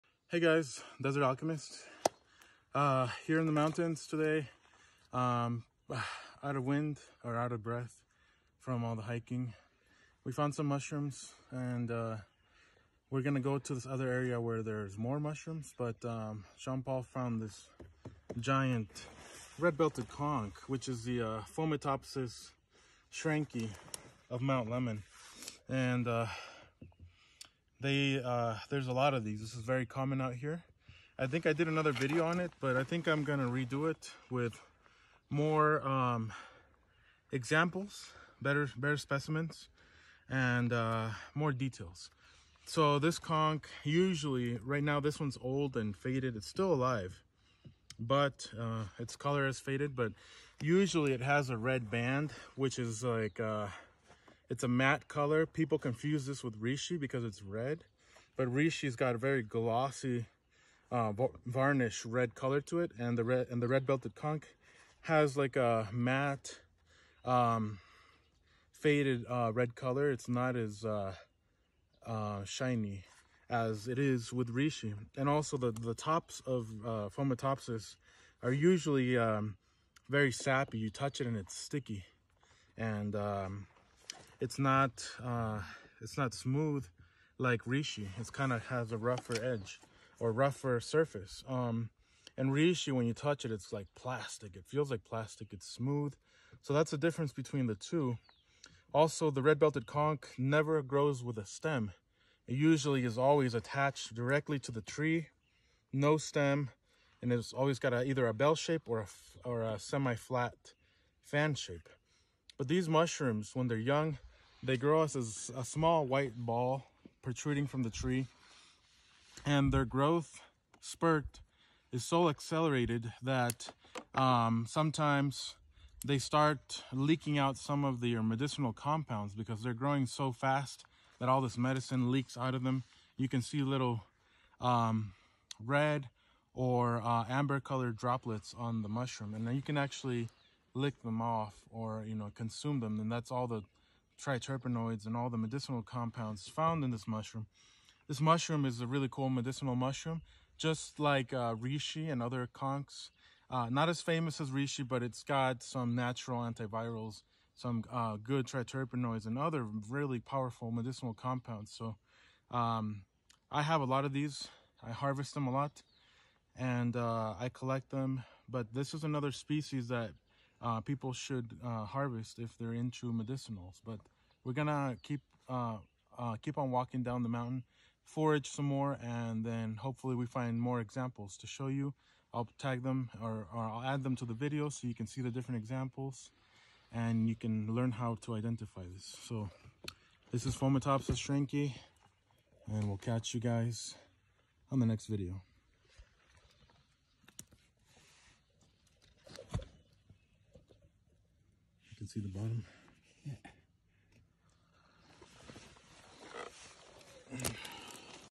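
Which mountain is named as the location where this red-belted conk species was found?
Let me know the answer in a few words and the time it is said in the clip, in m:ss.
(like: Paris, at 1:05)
Mount Lemmon, at 0:24.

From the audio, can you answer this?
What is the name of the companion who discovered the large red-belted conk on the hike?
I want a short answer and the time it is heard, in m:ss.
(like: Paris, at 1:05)
Jean Paul, at 0:16.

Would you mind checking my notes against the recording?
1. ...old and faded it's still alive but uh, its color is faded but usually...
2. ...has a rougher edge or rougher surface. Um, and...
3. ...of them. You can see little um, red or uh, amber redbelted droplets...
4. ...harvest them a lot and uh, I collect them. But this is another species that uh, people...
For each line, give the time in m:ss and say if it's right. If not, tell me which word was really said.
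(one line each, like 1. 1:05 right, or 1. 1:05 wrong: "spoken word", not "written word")
1. 0:45 right
2. 1:28 right
3. 2:12 wrong: "colored", not "redbelted"
4. 2:44 right.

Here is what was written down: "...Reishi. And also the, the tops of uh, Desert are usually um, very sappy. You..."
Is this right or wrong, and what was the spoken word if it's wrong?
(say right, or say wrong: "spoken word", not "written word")
wrong: "Fomitopsis", not "Desert".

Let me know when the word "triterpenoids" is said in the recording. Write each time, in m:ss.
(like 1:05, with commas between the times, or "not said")
2:24, 2:38.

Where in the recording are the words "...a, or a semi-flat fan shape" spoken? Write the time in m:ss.
1:49.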